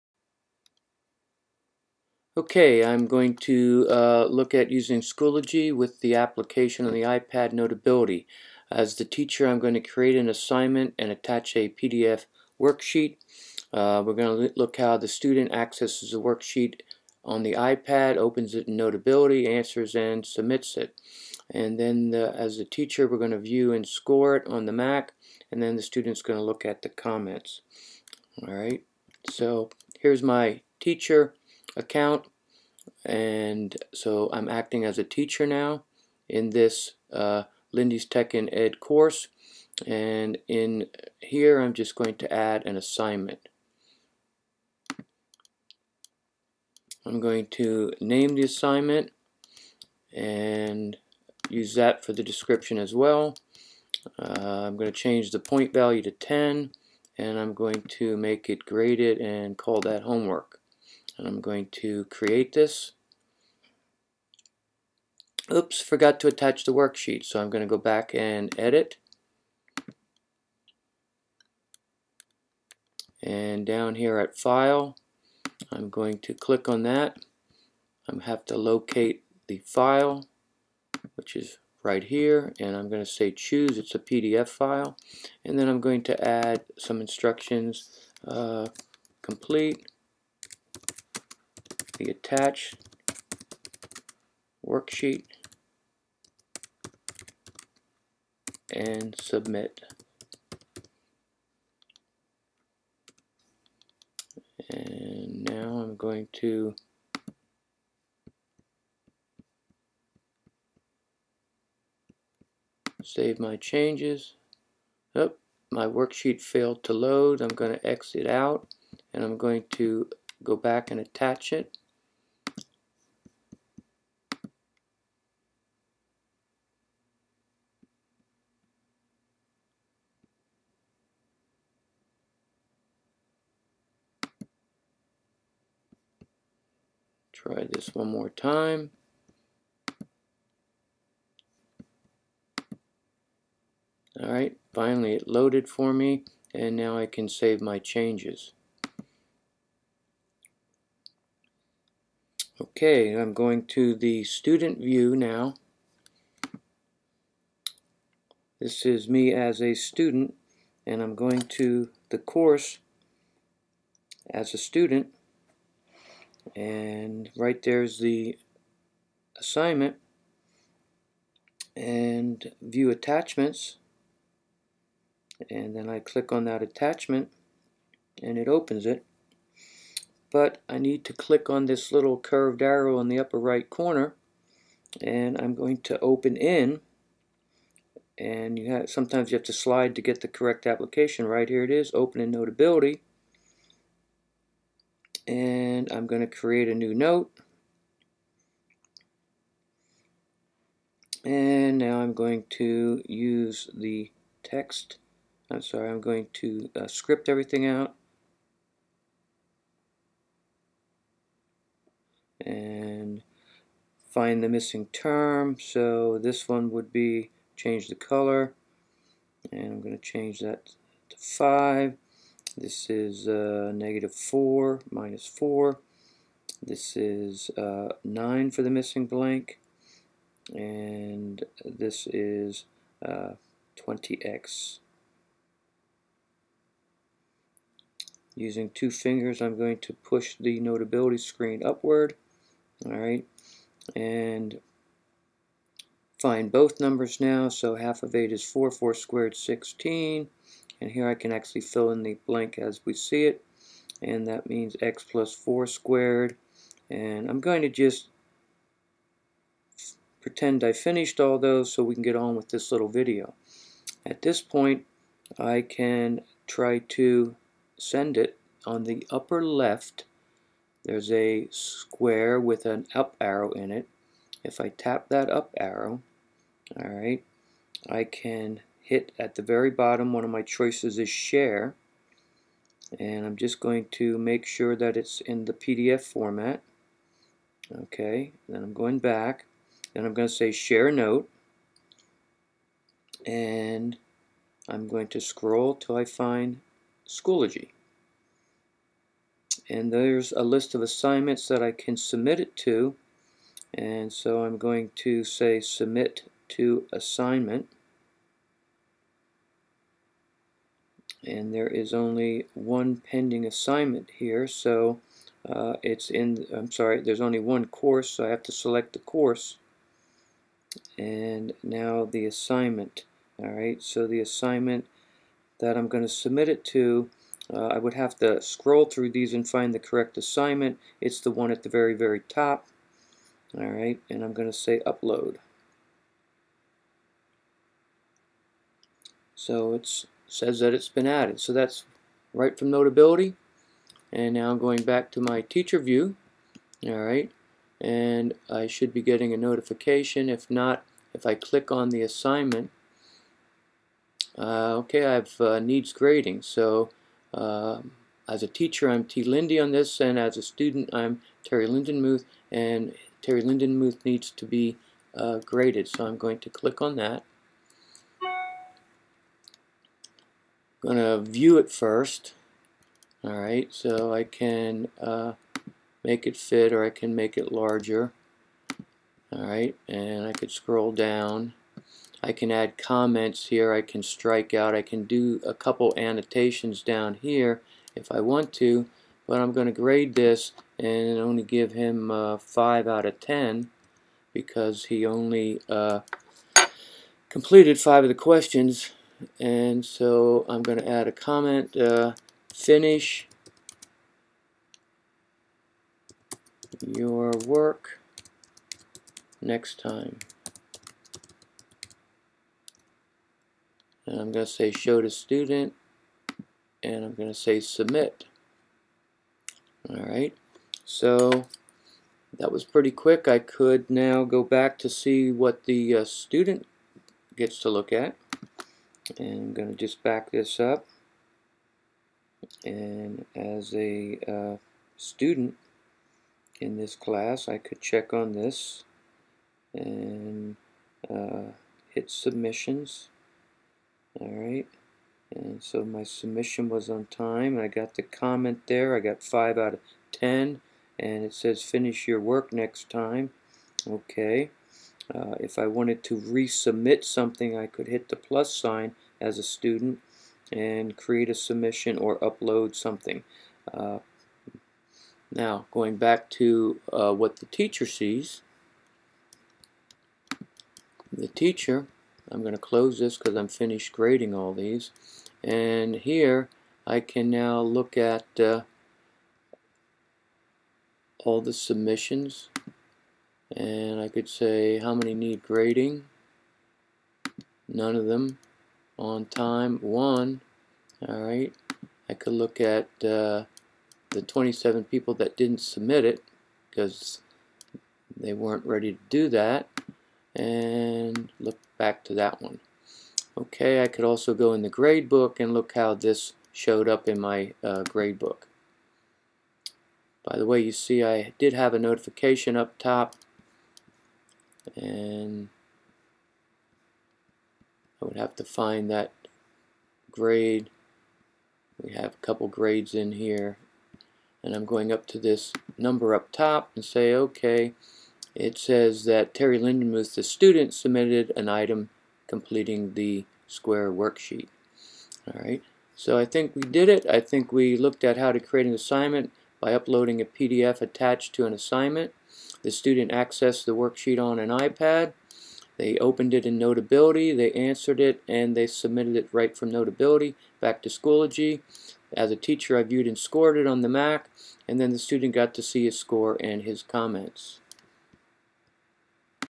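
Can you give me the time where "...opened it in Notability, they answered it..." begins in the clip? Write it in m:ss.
9:05.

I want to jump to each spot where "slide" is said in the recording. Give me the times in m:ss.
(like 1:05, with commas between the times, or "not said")
3:09.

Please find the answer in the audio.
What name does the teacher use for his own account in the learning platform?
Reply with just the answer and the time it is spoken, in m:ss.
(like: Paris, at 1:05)
T. Lindy, at 5:59.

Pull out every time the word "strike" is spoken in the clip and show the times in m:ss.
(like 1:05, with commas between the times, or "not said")
6:24.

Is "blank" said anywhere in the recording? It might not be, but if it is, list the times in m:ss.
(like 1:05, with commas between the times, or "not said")
3:49, 4:12.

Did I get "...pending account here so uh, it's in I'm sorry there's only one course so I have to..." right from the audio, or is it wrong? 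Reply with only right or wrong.
wrong.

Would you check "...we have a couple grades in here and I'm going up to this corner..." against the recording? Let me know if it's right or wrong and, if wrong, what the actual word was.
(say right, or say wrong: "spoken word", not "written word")
wrong: "number", not "corner".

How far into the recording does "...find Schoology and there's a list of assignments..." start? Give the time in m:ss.
4:56.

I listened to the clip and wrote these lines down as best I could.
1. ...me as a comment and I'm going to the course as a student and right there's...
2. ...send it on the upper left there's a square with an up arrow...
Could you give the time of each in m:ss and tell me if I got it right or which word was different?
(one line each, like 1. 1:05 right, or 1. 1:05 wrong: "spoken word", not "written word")
1. 2:39 wrong: "student", not "comment"
2. 4:27 right.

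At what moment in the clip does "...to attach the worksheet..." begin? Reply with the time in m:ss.
1:06.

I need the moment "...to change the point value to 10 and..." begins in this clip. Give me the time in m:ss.
0:54.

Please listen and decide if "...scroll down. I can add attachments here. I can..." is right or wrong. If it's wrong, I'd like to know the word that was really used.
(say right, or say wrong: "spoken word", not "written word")
wrong: "comments", not "attachments".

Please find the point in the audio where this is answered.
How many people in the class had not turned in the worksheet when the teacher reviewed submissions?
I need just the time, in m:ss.
8:14.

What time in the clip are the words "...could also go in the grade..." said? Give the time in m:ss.
8:23.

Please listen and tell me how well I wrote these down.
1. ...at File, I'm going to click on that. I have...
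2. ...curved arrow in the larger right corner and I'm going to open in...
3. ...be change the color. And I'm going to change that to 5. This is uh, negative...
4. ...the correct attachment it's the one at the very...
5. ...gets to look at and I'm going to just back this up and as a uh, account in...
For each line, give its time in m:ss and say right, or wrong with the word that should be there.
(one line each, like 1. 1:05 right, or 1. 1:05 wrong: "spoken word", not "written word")
1. 1:14 right
2. 3:02 wrong: "upper", not "larger"
3. 3:36 right
4. 5:29 wrong: "assignment", not "attachment"
5. 7:07 wrong: "student", not "account".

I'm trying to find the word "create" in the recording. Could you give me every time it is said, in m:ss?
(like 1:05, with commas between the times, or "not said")
0:09, 1:02, 3:16, 7:40, 8:58.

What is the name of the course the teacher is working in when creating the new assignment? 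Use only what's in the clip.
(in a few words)
Lindy's Tech and Ed.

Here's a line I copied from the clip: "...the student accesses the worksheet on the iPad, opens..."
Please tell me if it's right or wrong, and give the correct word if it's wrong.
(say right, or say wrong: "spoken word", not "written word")
right.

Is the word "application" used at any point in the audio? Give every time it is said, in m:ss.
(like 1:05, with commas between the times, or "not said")
0:06, 3:10.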